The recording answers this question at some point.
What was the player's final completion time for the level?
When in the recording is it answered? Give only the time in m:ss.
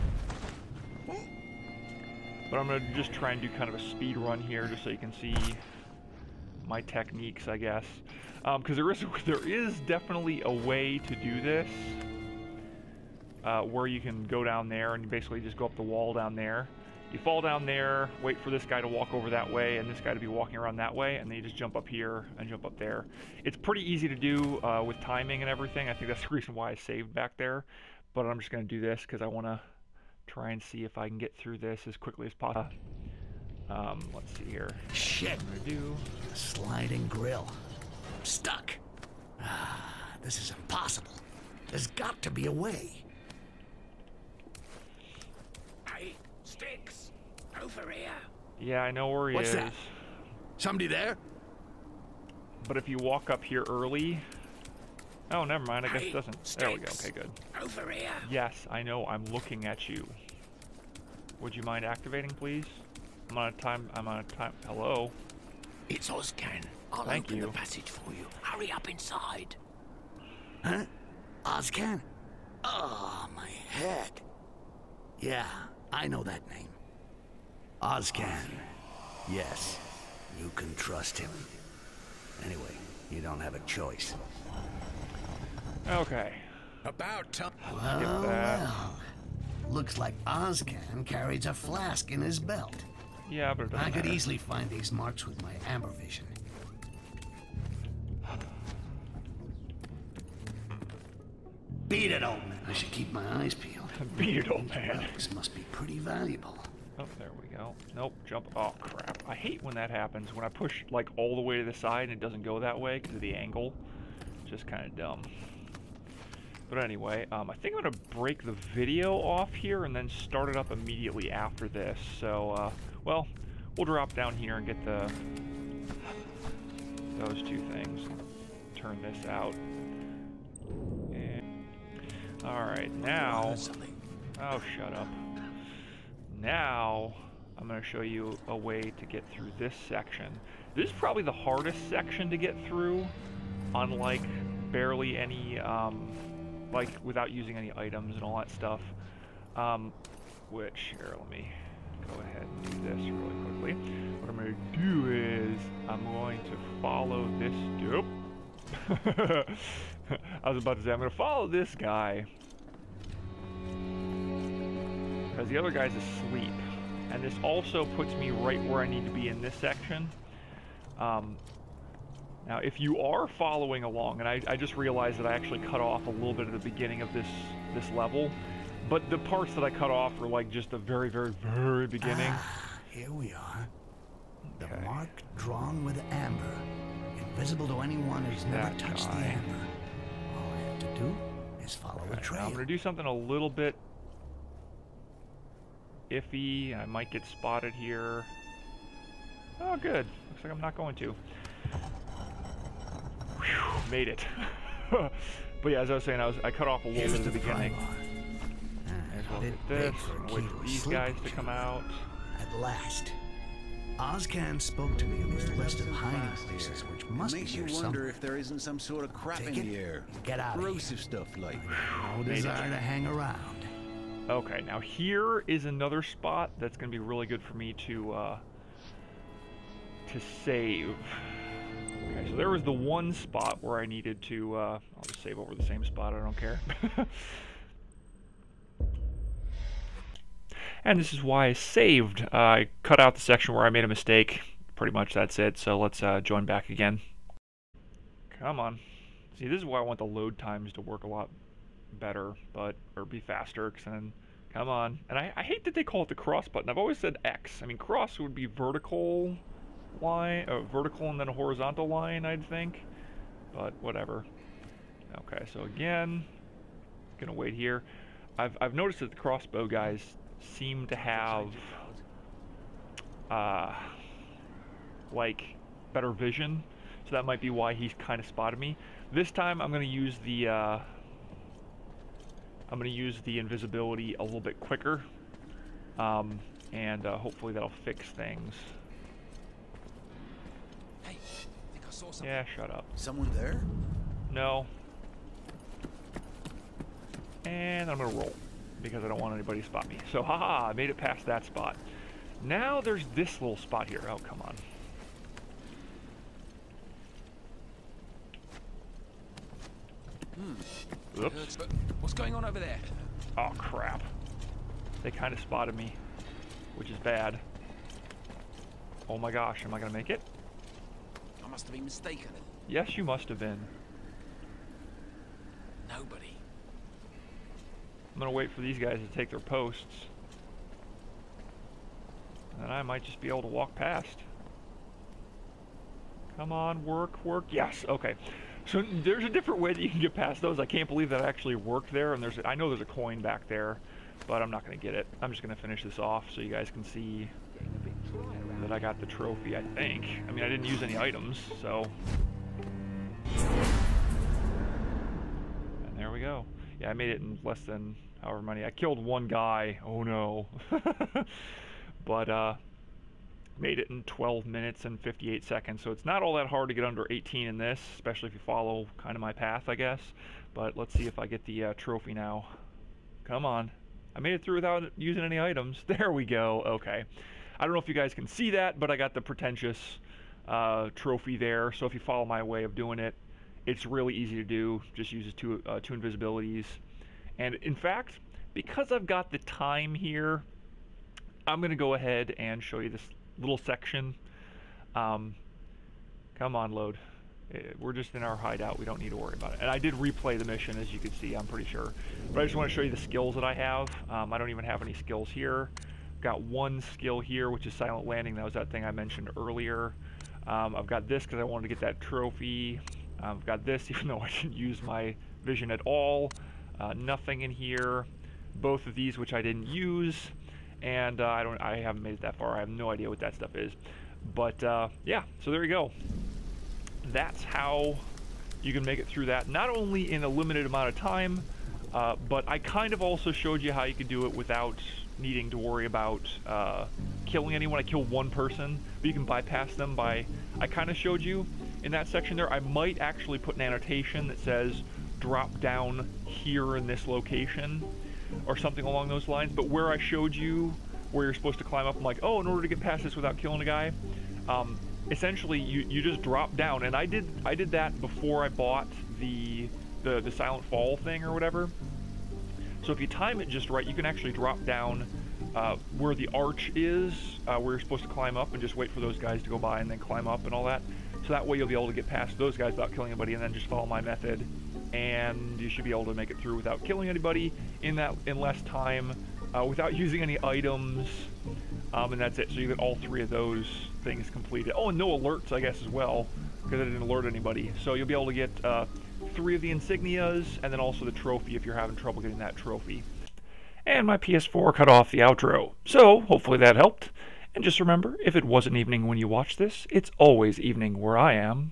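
6:04.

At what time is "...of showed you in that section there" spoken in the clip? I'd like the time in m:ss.
7:20.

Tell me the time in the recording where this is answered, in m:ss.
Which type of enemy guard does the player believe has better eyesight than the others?
4:29.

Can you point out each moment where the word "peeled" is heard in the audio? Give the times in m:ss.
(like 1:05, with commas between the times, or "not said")
1:43.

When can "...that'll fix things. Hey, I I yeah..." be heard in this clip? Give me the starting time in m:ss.
4:47.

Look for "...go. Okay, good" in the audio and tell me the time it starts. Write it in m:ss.
0:56.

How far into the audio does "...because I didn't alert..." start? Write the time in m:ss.
8:06.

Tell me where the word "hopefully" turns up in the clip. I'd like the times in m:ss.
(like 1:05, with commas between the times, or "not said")
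4:47, 8:16.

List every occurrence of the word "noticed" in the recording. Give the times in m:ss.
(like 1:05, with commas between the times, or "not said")
4:28.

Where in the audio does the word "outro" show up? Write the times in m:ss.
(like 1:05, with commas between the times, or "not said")
8:15.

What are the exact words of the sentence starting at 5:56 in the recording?
Yeah, I made it in less than however many.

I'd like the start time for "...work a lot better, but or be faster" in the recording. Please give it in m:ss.
4:10.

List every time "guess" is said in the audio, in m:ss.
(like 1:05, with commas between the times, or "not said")
0:07, 0:55, 6:09, 8:05.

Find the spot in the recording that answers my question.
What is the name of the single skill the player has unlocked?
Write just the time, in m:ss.
6:47.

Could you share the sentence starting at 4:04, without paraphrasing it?
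Pretty much that's it, so let's uh, join back again.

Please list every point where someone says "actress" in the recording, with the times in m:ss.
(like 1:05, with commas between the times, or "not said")
not said.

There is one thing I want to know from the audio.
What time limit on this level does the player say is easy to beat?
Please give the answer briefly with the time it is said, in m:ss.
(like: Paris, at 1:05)
18 minutes, at 6:06.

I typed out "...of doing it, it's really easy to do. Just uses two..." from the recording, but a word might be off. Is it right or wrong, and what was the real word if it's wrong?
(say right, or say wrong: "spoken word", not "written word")
right.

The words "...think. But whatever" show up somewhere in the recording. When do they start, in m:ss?
4:22.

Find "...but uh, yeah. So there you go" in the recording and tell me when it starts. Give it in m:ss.
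7:04.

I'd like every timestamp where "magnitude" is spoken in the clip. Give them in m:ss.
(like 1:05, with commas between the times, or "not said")
not said.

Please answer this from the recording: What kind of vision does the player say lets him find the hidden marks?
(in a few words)
Amber vision.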